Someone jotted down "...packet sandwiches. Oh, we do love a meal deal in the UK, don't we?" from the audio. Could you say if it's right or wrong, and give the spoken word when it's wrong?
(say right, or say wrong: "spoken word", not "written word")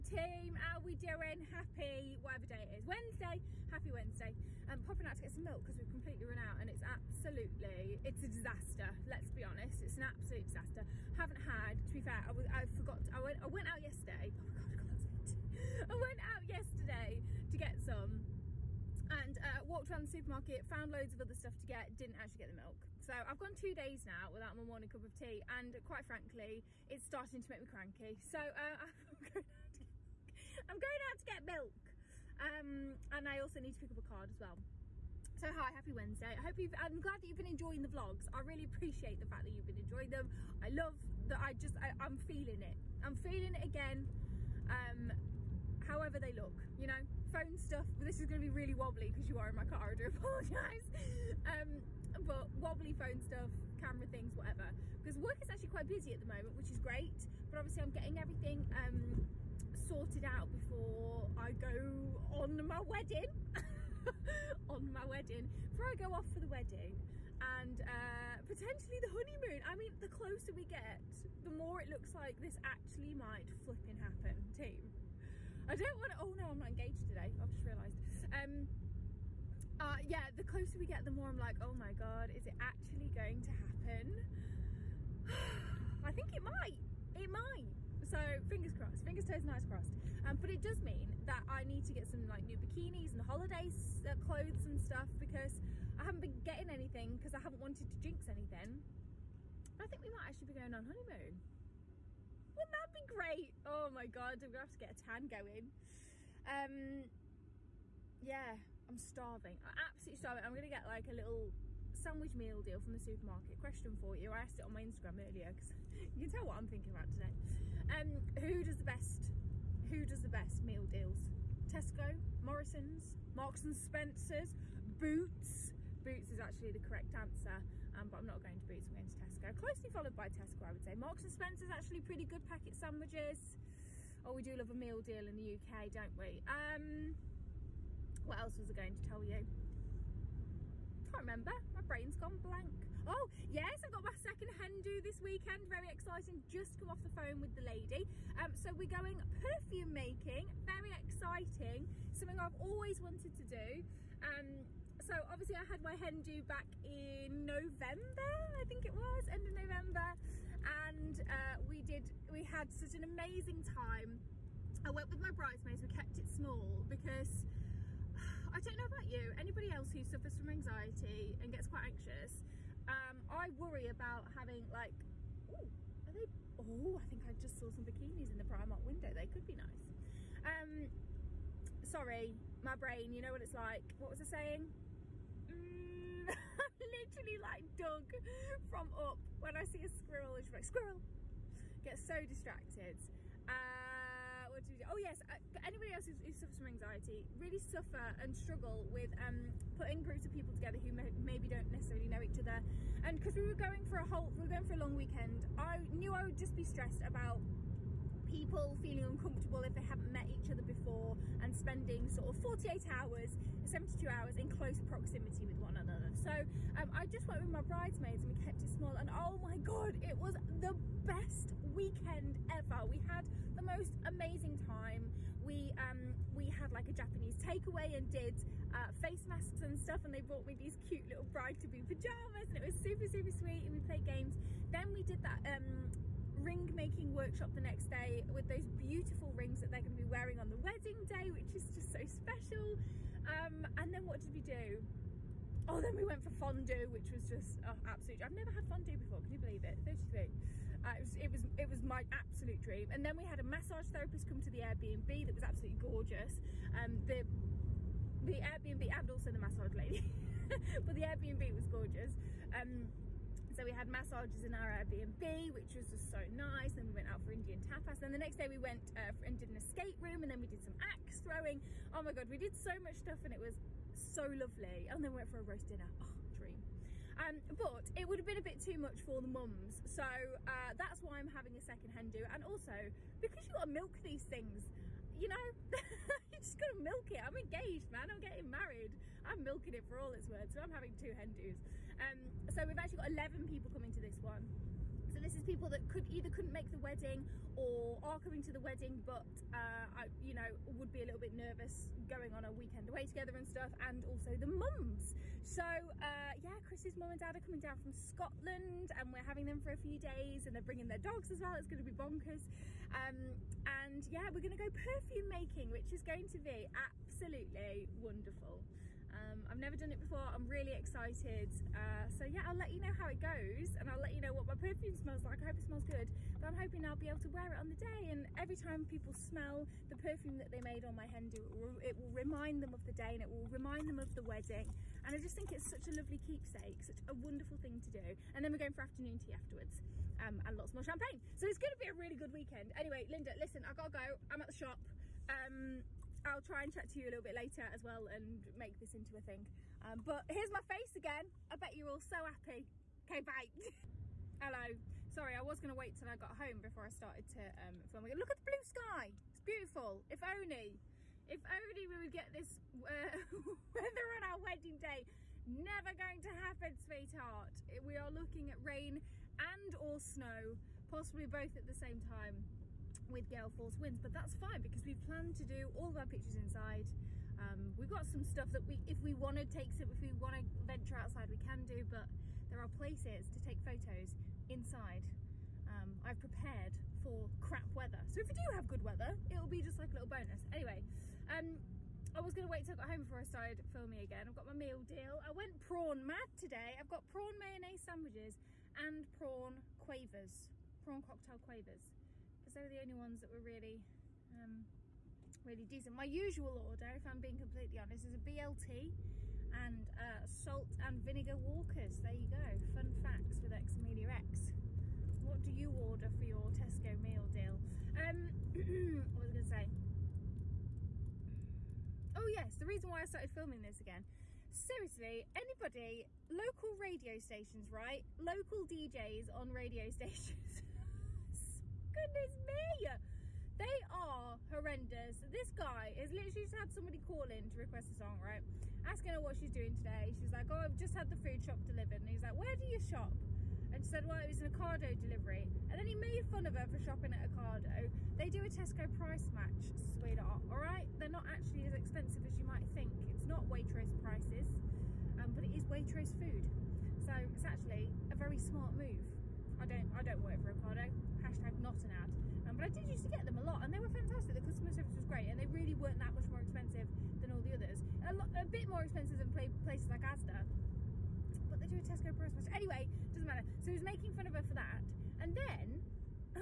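right.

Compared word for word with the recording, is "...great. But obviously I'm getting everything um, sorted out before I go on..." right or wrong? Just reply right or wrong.
right.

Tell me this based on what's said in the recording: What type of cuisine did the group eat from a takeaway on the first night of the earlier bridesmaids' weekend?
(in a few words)
Japanese.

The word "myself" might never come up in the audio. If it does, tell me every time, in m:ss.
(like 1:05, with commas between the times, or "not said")
not said.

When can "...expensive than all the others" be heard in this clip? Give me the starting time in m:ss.
7:46.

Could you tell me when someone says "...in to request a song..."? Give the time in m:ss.
7:17.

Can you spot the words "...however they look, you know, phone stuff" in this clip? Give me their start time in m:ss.
0:45.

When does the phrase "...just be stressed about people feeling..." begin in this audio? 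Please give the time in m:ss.
3:26.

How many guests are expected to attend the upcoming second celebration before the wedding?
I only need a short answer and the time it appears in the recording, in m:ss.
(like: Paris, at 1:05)
11, at 4:53.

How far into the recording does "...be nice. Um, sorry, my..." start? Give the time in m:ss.
2:59.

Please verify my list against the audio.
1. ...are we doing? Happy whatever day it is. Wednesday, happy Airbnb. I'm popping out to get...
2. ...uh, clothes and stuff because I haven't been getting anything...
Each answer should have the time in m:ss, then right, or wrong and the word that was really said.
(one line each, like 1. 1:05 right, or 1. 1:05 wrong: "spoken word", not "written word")
1. 0:00 wrong: "Wednesday", not "Airbnb"
2. 1:34 right.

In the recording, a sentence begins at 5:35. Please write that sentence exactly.
And I just think it's such a lovely keepsake, such a wonderful thing to do.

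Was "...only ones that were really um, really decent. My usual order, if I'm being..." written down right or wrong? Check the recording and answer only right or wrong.
right.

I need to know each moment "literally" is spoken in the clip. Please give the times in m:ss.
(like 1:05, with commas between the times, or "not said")
3:07, 7:16.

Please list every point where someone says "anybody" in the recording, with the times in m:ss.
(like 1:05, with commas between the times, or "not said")
2:49, 3:15, 7:05.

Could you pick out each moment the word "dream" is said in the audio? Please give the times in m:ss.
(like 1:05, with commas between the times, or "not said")
4:12, 4:36.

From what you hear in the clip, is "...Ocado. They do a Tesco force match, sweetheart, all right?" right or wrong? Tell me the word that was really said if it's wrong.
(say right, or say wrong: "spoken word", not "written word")
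wrong: "price", not "force".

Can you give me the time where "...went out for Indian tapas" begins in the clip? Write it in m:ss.
4:26.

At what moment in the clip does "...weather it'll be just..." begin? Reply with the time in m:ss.
6:28.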